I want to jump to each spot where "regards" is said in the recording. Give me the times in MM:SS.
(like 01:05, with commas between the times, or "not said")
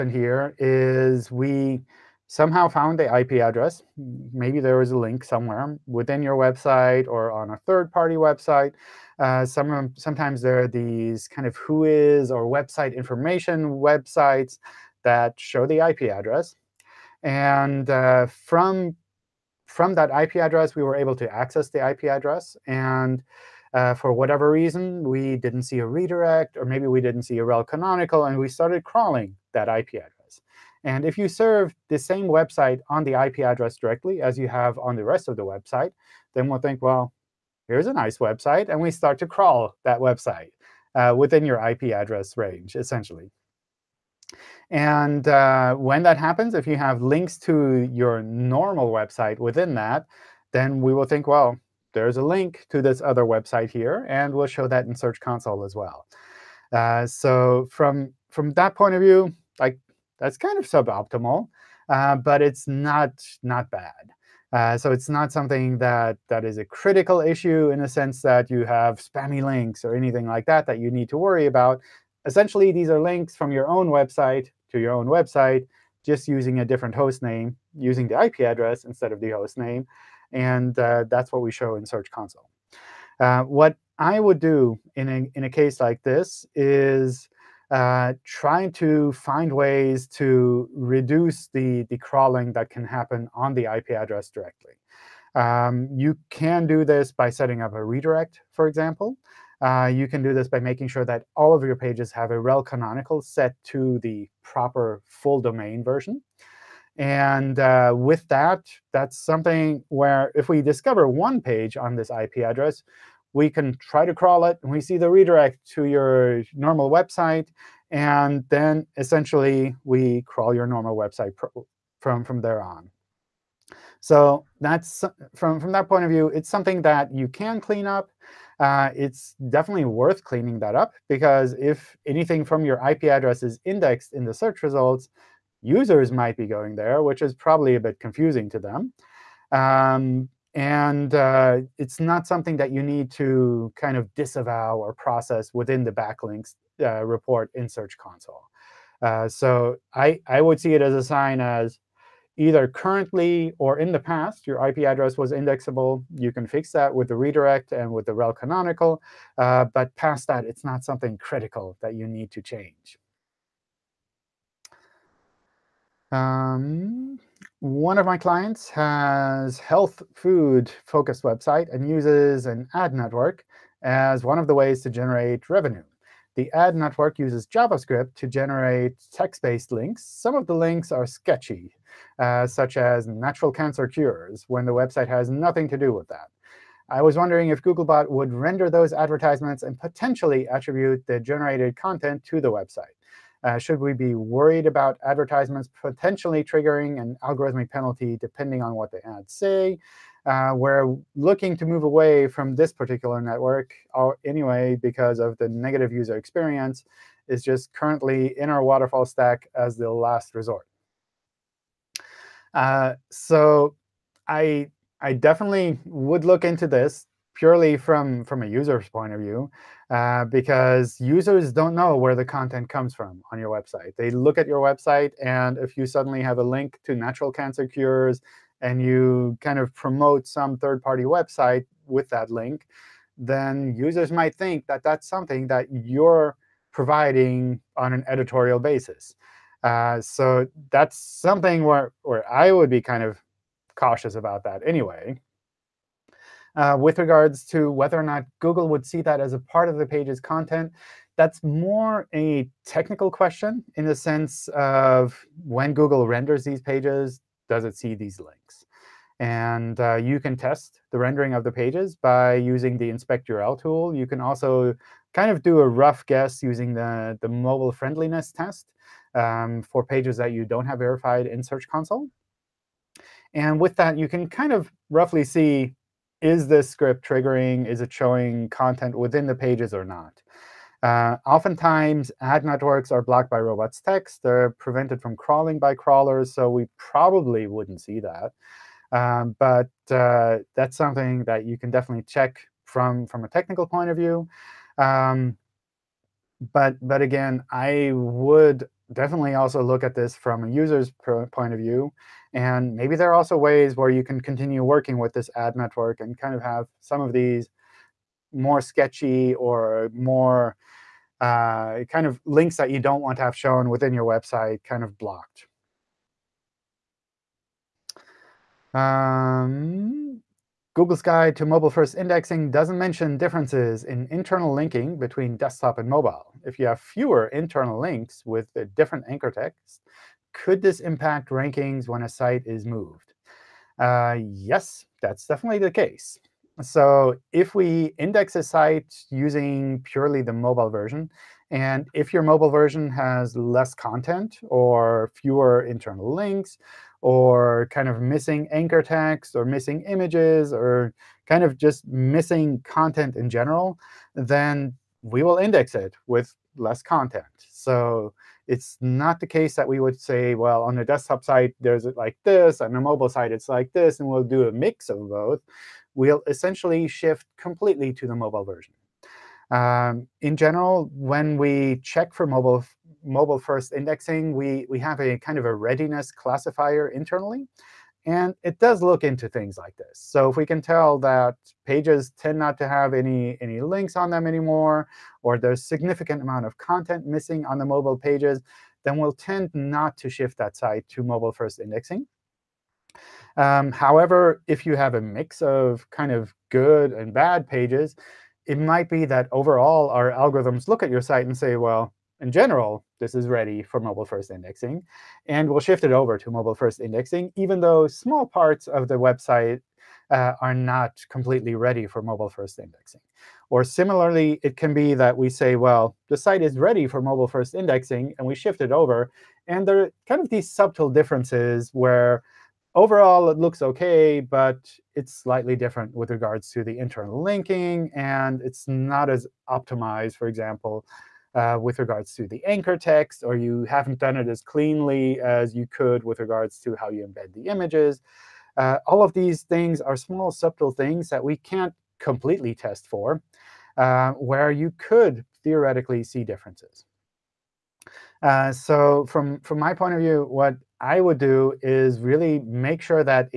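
04:06, 07:06, 07:11, 07:16.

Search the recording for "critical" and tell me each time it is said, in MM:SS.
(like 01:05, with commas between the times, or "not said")
01:06, 02:41.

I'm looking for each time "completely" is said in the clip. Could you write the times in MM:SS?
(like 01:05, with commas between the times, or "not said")
06:07, 06:51, 07:21.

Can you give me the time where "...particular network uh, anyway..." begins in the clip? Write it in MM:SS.
03:22.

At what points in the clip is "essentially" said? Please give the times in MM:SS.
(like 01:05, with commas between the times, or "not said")
00:42, 01:12, 01:58, 06:06.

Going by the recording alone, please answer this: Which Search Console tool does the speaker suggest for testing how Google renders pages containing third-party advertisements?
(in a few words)
inspect URL tool.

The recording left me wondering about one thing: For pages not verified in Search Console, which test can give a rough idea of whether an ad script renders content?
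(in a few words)
mobile friendliness test.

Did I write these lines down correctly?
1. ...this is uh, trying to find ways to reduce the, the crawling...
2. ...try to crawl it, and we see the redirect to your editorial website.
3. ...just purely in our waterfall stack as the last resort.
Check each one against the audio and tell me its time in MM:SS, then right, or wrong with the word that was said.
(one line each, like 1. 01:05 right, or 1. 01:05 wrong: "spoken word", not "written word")
1. 01:26 right
2. 01:53 wrong: "normal", not "editorial"
3. 03:27 wrong: "currently", not "purely".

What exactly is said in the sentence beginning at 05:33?
Uh, yes, that's definitely the case.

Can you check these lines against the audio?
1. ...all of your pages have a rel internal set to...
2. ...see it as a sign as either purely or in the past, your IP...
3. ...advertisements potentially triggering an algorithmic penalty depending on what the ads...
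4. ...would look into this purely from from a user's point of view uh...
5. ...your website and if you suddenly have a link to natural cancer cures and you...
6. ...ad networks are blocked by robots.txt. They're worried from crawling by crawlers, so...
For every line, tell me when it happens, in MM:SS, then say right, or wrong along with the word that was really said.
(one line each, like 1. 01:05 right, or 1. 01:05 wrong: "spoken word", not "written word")
1. 01:41 wrong: "canonical", not "internal"
2. 02:30 wrong: "currently", not "purely"
3. 03:15 right
4. 03:35 right
5. 03:44 right
6. 04:42 wrong: "prevented", not "worried".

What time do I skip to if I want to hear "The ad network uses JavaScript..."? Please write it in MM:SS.
02:56.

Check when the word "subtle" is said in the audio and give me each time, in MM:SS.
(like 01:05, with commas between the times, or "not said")
07:00, 07:20.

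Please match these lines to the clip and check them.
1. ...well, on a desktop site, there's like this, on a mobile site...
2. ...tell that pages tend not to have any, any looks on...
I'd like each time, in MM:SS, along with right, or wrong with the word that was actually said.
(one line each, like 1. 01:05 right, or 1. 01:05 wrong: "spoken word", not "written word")
1. 06:00 right
2. 06:20 wrong: "links", not "looks".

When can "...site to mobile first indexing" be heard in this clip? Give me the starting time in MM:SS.
06:30.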